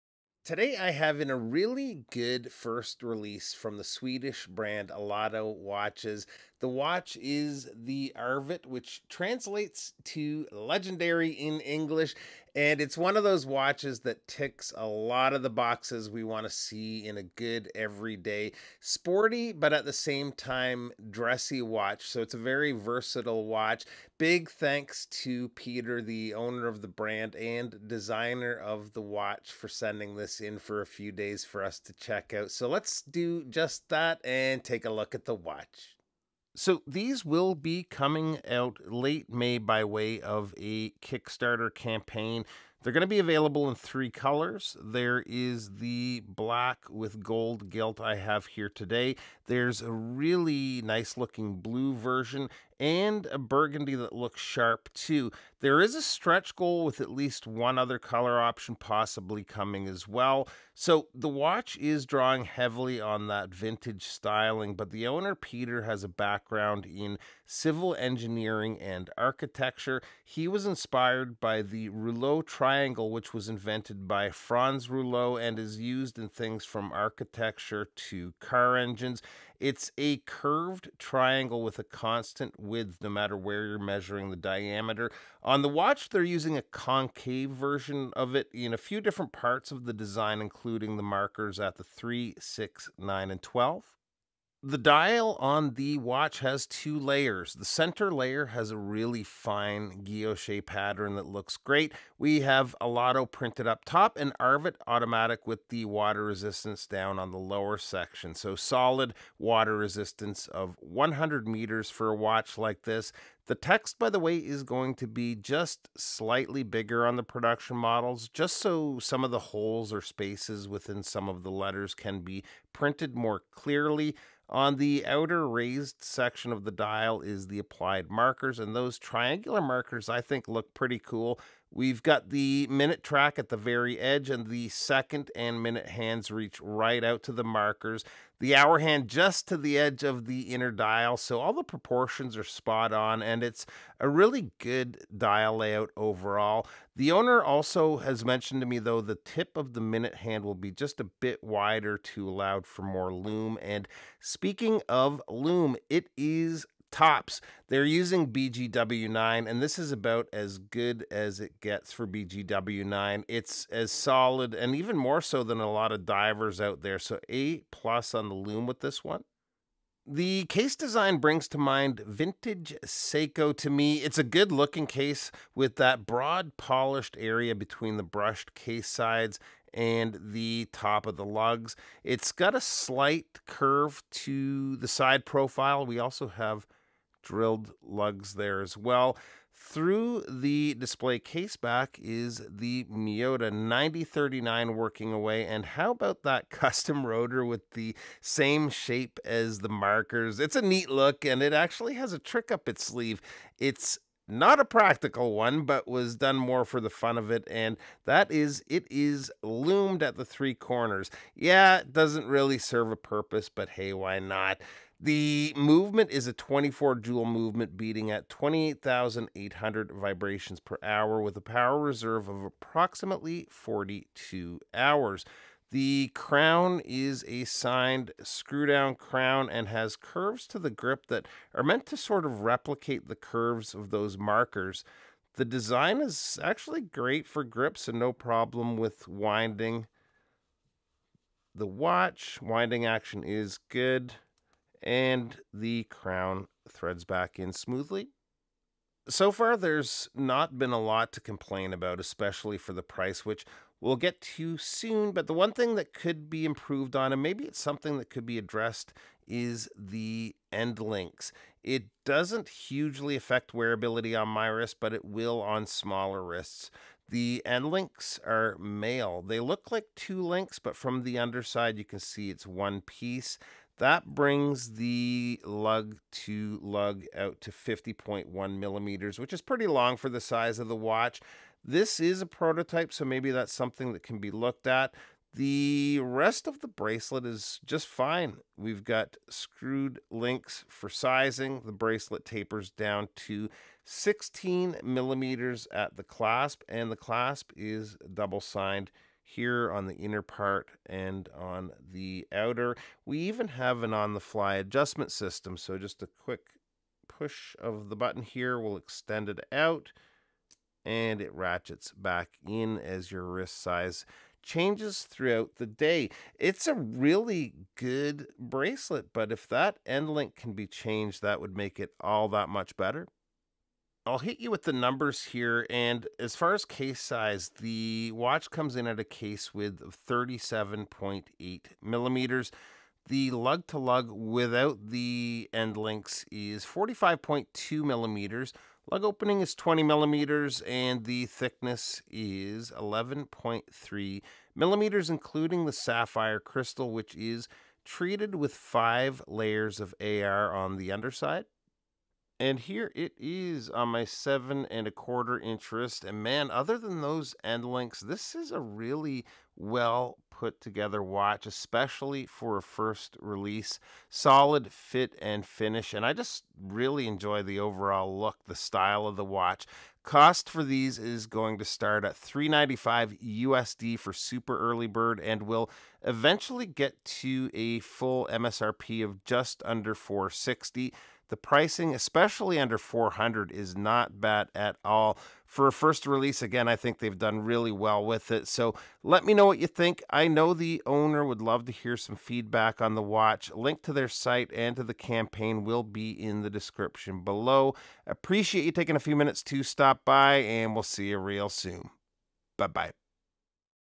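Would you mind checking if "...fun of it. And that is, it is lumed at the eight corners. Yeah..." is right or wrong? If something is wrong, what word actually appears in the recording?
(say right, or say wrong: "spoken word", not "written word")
wrong: "three", not "eight".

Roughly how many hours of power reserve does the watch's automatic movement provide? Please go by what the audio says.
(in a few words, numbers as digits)
42.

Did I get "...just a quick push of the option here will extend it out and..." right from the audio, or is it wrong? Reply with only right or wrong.
wrong.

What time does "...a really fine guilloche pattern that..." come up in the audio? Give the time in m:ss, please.
1:38.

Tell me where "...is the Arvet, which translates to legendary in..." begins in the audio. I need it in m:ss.
0:07.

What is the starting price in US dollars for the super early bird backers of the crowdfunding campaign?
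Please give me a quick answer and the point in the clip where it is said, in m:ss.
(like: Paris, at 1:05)
395, at 6:12.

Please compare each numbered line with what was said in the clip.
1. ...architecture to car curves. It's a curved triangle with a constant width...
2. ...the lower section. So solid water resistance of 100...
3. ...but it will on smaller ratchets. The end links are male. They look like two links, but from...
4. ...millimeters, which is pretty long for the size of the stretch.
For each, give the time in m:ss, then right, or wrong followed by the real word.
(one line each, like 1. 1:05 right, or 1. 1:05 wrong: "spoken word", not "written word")
1. 1:16 wrong: "engines", not "curves"
2. 1:47 right
3. 4:24 wrong: "wrists", not "ratchets"
4. 4:38 wrong: "watch", not "stretch".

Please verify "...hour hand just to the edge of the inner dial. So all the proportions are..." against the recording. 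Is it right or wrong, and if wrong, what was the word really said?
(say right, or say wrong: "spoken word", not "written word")
right.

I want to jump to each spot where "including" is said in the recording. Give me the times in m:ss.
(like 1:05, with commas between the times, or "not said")
1:30, 5:45.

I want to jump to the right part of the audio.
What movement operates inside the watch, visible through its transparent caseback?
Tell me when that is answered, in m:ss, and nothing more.
3:12.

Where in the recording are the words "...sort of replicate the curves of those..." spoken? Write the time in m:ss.
3:51.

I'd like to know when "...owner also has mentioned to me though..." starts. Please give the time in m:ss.
2:27.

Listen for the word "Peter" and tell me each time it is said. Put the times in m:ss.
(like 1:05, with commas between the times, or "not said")
0:25, 1:05.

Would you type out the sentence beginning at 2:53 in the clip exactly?
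It's a good looking case with that broad polished area between the brushed case sides and the top of the lugs.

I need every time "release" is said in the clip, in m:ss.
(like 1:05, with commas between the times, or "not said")
0:03, 6:03, 6:26.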